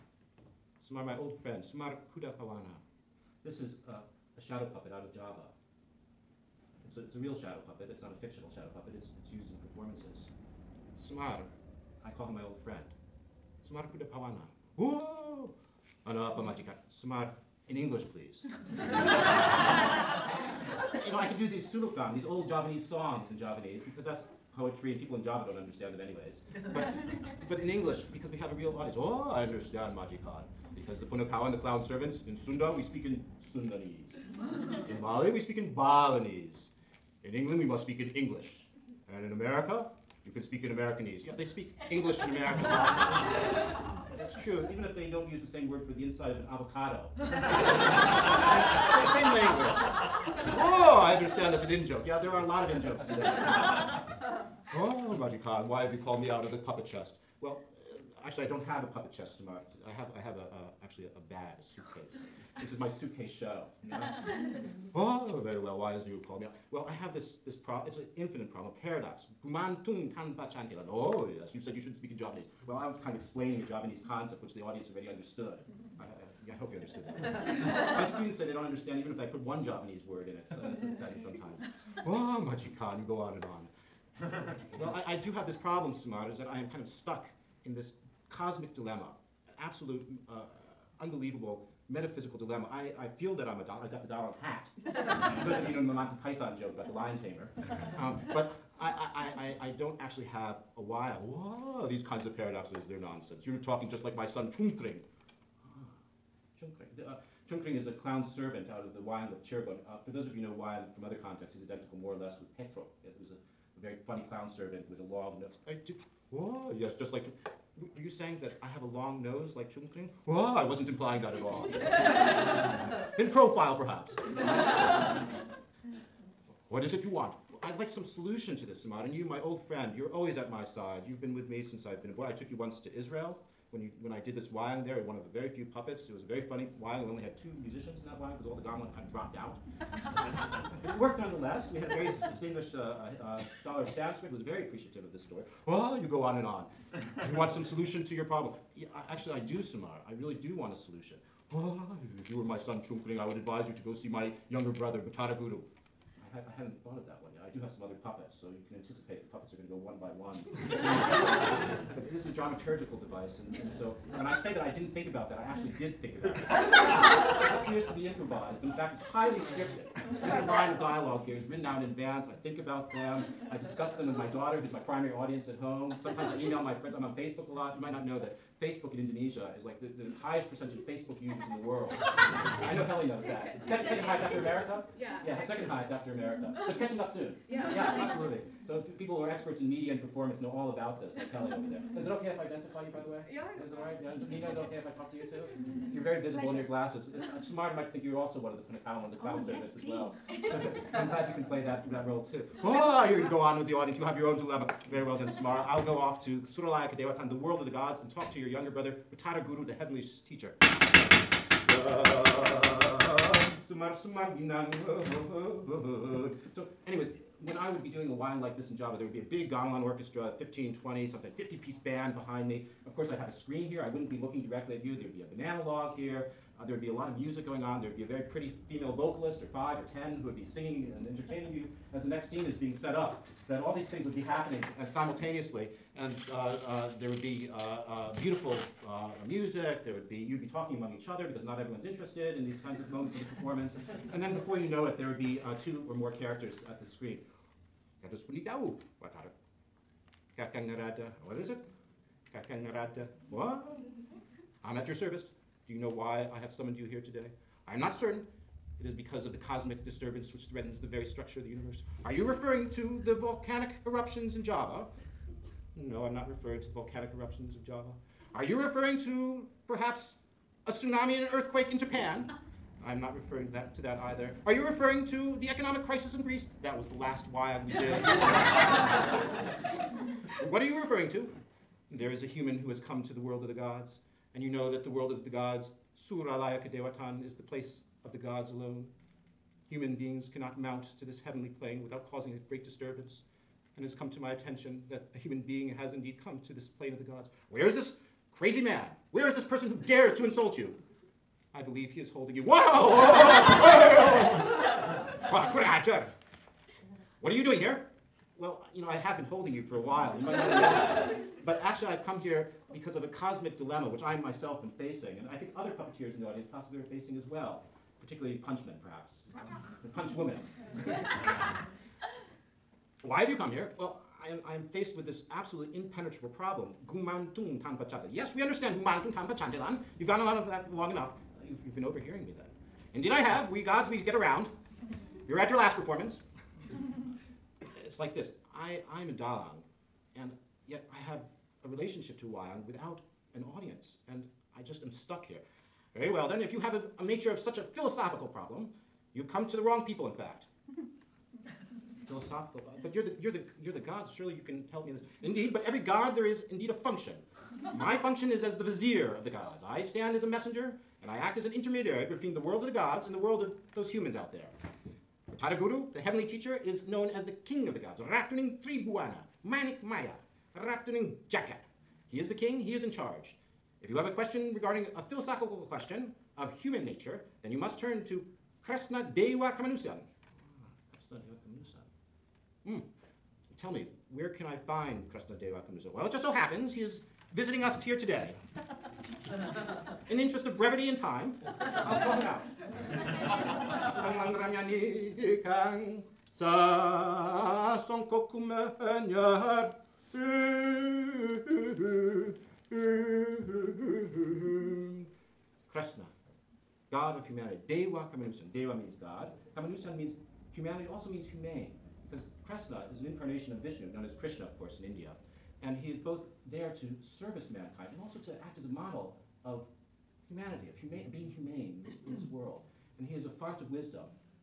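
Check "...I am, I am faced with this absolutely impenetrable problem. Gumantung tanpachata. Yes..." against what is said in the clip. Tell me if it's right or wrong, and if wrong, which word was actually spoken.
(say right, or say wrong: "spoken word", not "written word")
right.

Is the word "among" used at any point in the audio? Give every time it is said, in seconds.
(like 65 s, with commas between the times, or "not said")
240 s.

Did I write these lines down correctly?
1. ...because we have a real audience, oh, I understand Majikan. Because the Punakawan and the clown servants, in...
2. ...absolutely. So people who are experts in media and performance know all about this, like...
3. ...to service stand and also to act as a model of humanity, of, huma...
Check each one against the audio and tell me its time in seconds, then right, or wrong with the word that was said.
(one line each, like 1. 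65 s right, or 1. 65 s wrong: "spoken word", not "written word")
1. 28 s right
2. 188 s right
3. 416 s wrong: "mankind", not "stand".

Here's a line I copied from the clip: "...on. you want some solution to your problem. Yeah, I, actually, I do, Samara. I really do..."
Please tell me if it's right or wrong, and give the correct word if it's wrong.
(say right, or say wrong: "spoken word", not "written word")
right.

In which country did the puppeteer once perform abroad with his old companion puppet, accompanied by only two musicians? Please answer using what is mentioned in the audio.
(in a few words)
Israel.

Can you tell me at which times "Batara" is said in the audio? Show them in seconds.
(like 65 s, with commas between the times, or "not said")
154 s, 209 s, 365 s.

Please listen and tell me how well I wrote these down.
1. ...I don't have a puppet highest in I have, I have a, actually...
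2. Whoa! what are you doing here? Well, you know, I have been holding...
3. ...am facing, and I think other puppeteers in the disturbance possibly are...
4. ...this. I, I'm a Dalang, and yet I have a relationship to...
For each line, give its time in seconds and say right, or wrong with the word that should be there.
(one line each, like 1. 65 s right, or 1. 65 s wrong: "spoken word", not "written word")
1. 58 s wrong: "chest", not "highest"
2. 302 s right
3. 314 s wrong: "audience", not "disturbance"
4. 338 s right.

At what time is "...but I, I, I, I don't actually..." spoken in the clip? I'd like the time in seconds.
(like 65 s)
98 s.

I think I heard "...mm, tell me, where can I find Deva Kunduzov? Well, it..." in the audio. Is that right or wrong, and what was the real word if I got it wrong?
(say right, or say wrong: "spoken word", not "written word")
right.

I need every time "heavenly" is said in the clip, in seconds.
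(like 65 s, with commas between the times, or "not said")
209 s, 291 s, 365 s.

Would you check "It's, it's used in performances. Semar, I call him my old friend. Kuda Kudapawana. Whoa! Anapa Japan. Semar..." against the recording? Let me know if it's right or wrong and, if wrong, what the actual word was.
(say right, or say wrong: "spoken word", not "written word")
wrong: "Majika", not "Japan".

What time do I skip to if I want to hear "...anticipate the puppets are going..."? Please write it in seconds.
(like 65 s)
158 s.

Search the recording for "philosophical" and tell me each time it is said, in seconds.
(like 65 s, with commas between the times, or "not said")
347 s, 352 s, 375 s.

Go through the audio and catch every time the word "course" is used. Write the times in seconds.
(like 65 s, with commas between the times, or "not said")
222 s, 414 s.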